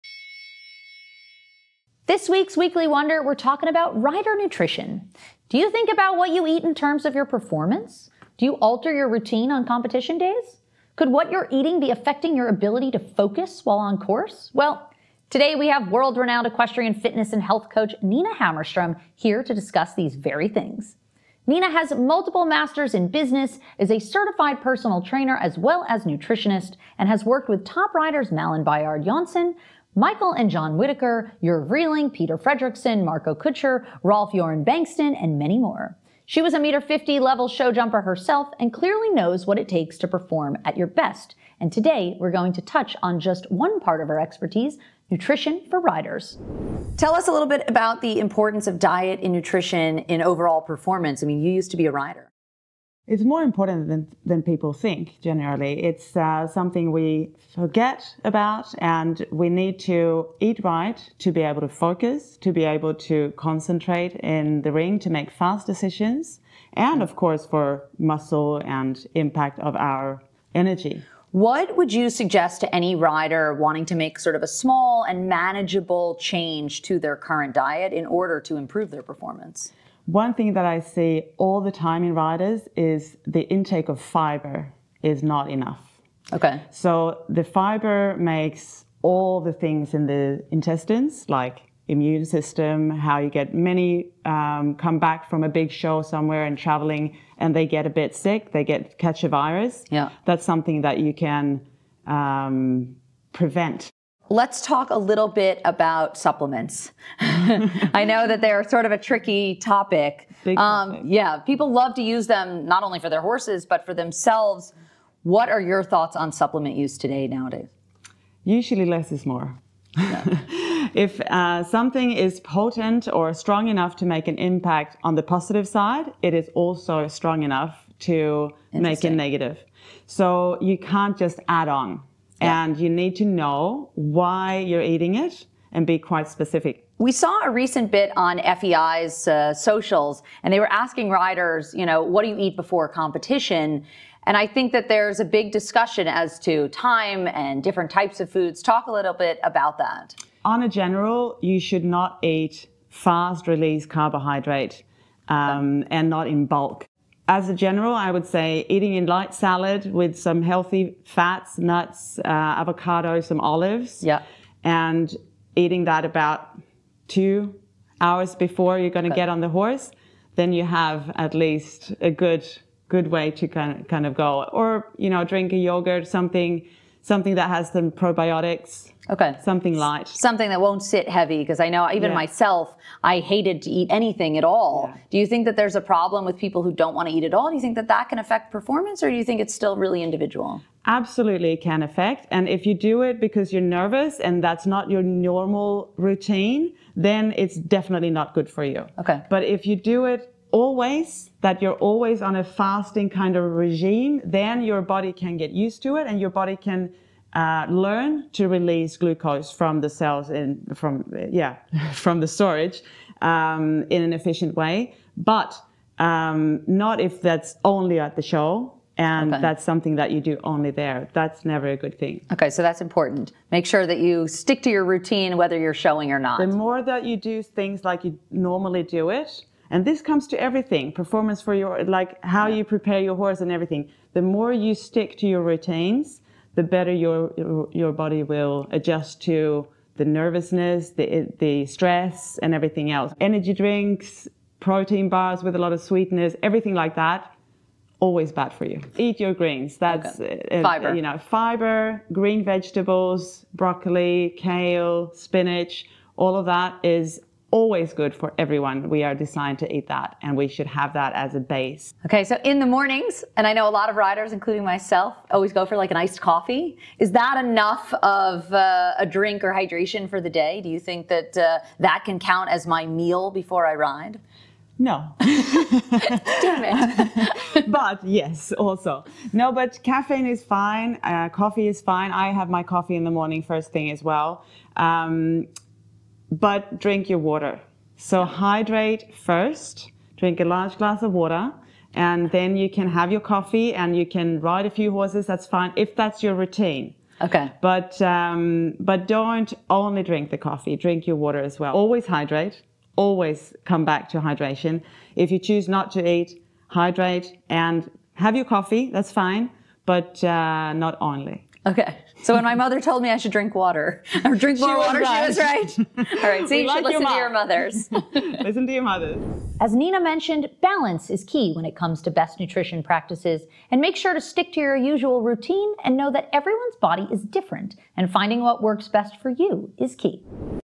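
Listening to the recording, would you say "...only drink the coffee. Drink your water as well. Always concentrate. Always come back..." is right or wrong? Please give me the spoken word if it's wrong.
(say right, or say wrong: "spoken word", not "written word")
wrong: "hydrate", not "concentrate".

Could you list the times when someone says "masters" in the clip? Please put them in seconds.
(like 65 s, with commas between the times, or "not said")
22 s.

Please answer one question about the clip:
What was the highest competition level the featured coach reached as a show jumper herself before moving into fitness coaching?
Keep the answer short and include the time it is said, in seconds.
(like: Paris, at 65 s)
1.50 meter, at 36 s.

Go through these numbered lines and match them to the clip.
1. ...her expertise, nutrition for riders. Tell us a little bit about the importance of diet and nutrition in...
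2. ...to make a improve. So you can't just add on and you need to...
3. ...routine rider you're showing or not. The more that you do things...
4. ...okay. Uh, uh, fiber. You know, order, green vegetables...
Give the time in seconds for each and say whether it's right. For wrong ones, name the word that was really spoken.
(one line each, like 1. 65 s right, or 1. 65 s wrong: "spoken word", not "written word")
1. 44 s right
2. 127 s wrong: "negative", not "improve"
3. 224 s wrong: "whether", not "rider"
4. 250 s wrong: "fiber", not "order".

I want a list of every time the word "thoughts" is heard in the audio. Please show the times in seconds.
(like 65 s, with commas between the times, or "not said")
115 s.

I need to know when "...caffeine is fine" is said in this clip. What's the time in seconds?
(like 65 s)
279 s.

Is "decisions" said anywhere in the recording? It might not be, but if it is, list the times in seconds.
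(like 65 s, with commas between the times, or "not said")
65 s.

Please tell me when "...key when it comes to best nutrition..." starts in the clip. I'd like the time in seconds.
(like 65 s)
321 s.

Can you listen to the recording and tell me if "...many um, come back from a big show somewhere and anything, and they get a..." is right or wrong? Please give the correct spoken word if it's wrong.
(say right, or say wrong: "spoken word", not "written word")
wrong: "traveling", not "anything".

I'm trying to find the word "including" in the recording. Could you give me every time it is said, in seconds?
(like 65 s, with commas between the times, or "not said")
264 s.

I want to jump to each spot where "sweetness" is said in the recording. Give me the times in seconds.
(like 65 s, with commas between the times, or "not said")
245 s.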